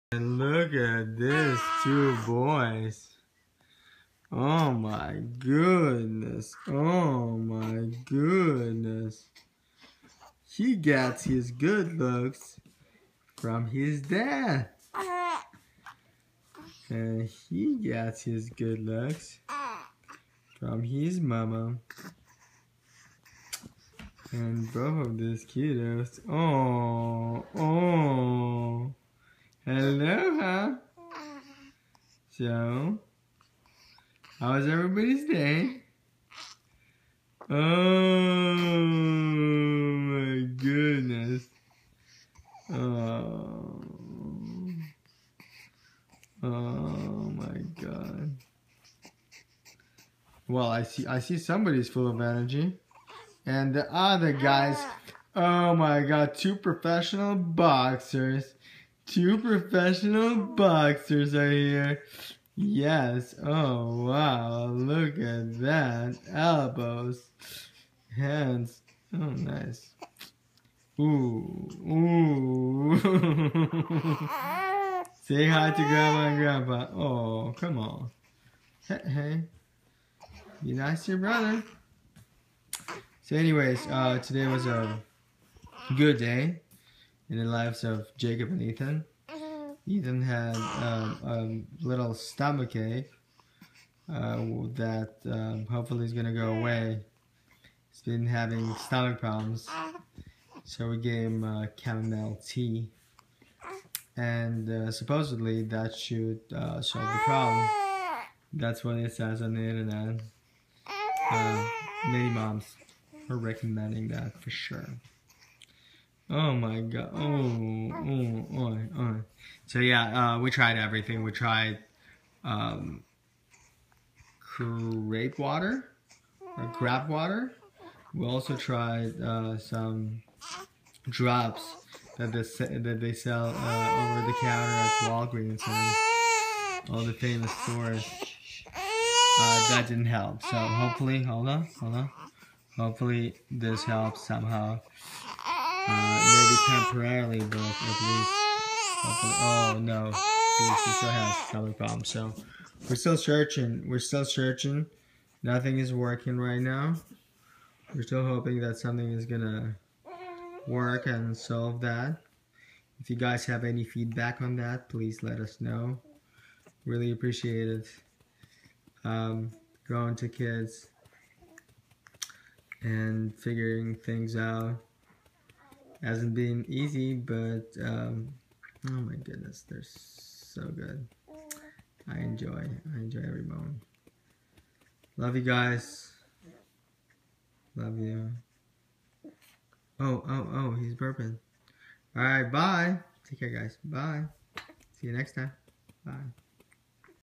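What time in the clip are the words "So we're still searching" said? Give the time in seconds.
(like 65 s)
152 s.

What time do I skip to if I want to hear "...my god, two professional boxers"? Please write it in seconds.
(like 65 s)
55 s.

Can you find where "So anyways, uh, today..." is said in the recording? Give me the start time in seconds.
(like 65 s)
83 s.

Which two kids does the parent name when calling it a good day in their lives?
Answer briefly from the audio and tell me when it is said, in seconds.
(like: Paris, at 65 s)
Jacob and Ethan, at 88 s.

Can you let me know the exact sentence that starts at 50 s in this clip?
Well, I see I see somebody's full of energy.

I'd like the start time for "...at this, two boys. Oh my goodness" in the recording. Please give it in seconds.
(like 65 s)
0 s.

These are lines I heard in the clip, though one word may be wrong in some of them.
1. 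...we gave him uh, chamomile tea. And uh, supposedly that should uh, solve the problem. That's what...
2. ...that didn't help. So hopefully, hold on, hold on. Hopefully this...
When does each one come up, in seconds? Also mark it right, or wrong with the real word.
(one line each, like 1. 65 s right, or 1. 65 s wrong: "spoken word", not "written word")
1. 100 s right
2. 139 s right.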